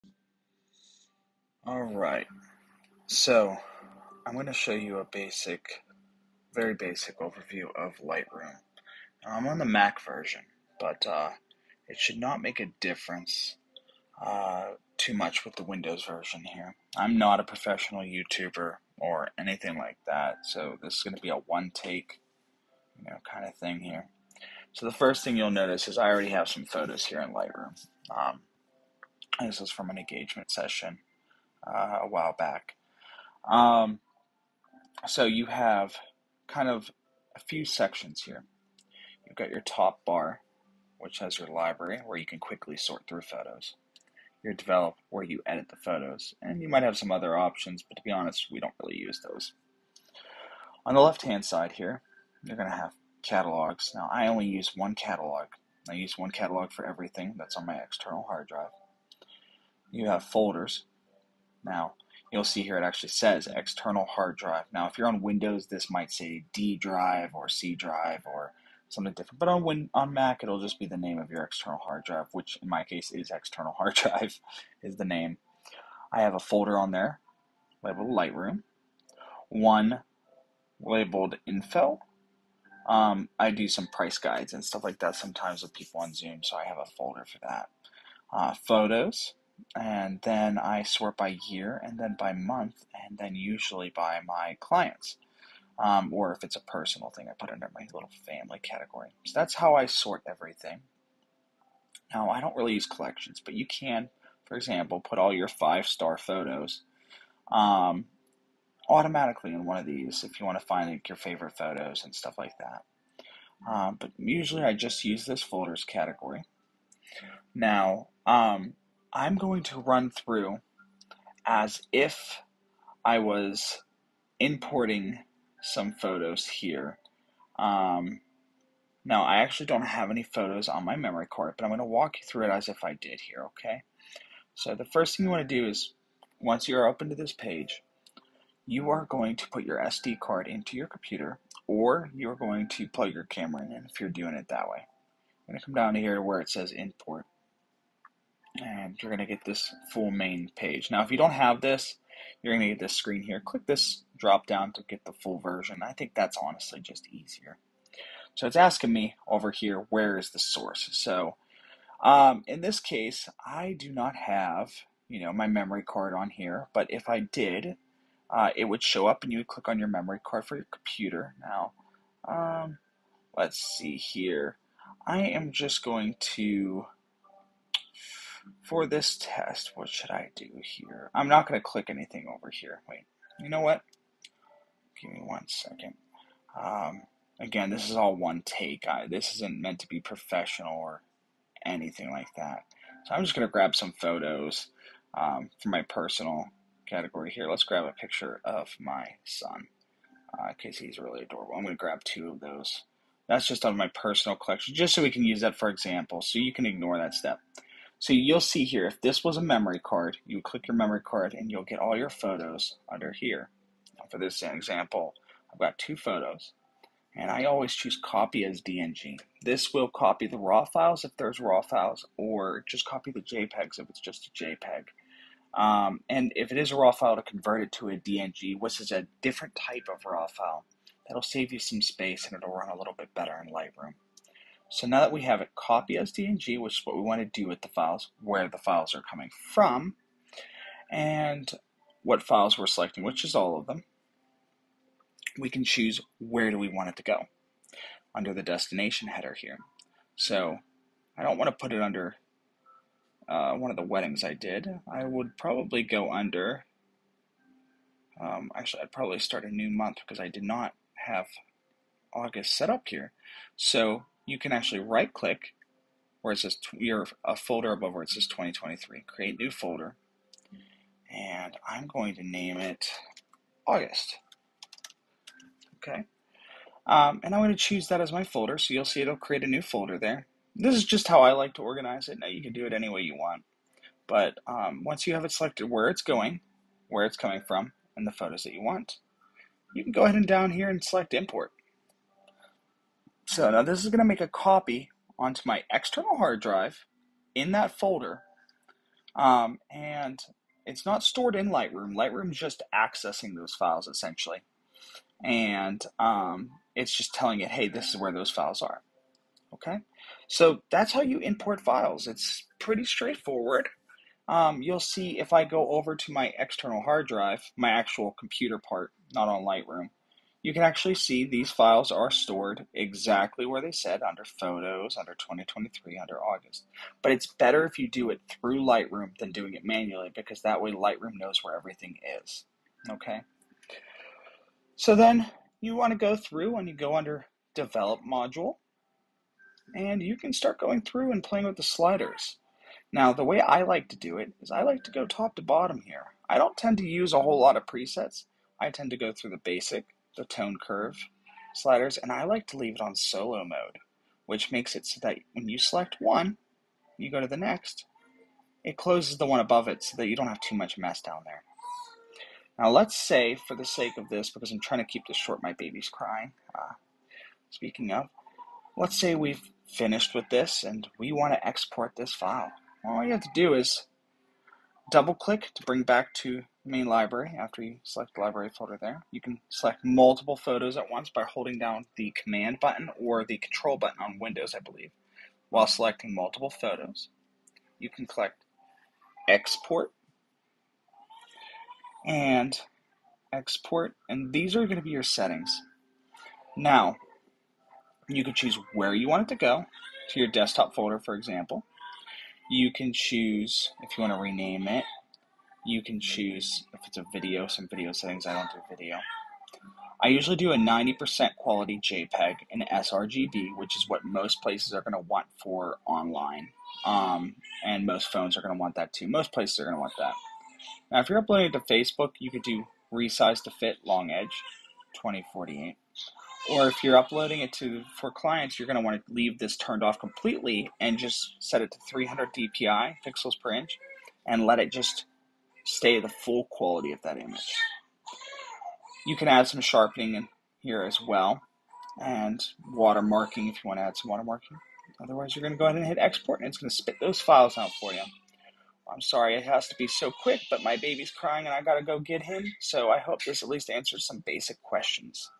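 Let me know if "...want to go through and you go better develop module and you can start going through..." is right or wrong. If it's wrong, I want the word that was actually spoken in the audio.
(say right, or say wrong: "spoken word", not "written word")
wrong: "under", not "better".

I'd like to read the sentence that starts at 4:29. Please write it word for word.
Create new folder, and I'm going to name it August.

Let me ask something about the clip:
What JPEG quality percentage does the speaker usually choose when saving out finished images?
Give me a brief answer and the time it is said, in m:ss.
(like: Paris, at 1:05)
90%, at 6:50.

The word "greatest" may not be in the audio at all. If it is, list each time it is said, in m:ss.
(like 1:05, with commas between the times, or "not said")
not said.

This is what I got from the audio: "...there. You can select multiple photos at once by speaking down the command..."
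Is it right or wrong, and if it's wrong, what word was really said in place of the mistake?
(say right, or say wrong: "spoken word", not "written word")
wrong: "holding", not "speaking".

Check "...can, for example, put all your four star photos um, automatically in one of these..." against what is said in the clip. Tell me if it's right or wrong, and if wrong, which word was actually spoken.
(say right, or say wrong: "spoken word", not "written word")
wrong: "five", not "four".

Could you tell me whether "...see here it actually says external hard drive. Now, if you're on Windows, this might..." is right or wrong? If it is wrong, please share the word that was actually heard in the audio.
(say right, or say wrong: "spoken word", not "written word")
right.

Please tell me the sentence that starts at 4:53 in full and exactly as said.
So now this is going to make a copy onto my external hard drive in that folder.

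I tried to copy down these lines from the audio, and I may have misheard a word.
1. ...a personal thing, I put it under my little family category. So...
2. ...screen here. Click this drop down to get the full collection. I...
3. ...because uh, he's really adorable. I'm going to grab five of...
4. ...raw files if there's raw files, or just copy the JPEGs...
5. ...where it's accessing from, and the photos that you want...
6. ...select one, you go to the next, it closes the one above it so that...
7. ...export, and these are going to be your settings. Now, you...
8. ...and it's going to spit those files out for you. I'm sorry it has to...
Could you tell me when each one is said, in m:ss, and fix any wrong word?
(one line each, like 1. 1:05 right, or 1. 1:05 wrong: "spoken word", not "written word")
1. 1:36 right
2. 2:32 wrong: "version", not "collection"
3. 3:20 wrong: "two", not "five"
4. 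3:40 right
5. 4:46 wrong: "coming", not "accessing"
6. 5:55 right
7. 6:33 right
8. 7:26 right.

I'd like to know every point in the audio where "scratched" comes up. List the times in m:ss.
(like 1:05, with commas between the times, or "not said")
not said.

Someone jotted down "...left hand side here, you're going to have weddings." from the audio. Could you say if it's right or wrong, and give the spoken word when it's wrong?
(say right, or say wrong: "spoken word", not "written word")
wrong: "catalogs", not "weddings".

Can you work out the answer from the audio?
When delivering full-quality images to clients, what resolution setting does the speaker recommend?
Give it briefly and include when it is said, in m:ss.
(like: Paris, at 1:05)
300 dpi, at 7:11.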